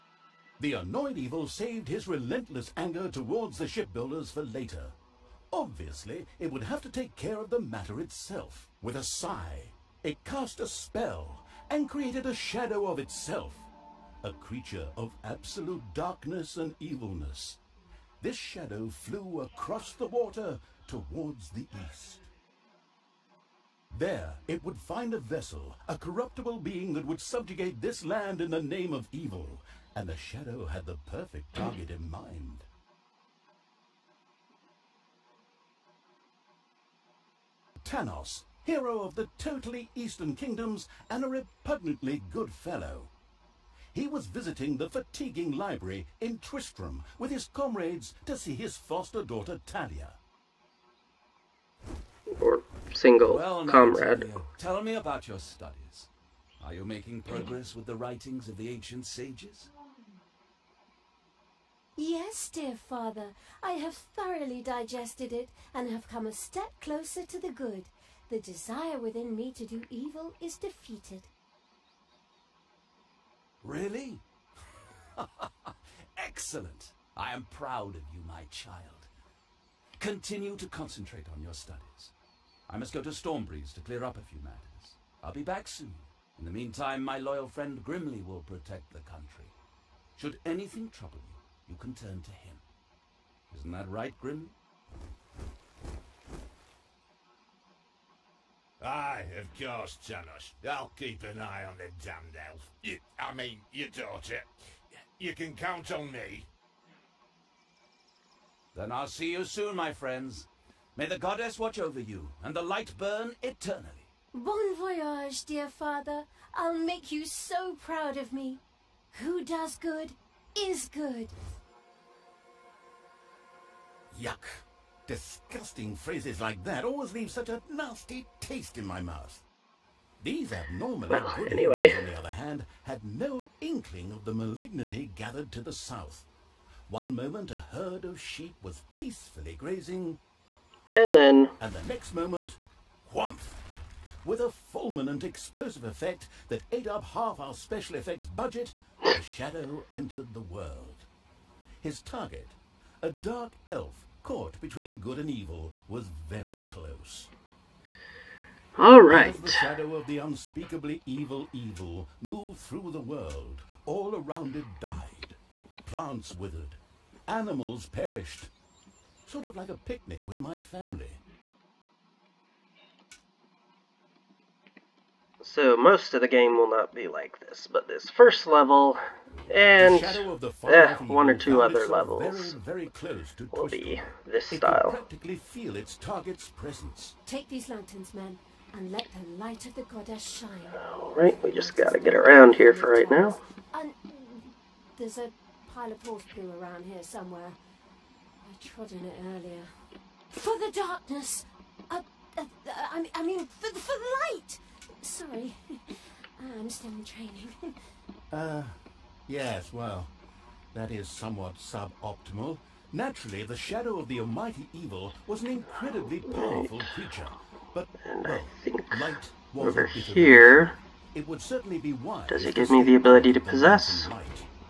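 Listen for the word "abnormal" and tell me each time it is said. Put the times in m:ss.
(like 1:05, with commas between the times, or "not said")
2:10.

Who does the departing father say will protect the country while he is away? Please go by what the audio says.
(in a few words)
Grimly.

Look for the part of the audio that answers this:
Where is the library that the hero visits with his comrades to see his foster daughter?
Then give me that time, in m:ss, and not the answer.
0:46.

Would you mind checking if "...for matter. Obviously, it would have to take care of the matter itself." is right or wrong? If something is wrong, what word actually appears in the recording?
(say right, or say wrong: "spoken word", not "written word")
wrong: "later", not "matter".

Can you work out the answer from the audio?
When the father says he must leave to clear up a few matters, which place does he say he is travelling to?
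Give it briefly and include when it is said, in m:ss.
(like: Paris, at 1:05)
Stormbreeze, at 1:23.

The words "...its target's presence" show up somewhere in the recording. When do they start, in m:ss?
3:05.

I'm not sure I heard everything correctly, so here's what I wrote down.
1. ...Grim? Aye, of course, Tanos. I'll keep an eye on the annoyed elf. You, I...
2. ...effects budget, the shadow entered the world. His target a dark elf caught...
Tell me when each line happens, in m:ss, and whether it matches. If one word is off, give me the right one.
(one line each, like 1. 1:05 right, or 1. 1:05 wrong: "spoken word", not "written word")
1. 1:34 wrong: "damned", not "annoyed"
2. 2:27 right.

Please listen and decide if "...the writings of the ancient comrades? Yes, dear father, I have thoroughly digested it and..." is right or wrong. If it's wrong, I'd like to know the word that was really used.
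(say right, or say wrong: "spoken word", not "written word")
wrong: "sages", not "comrades".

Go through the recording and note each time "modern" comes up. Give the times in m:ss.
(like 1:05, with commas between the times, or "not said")
not said.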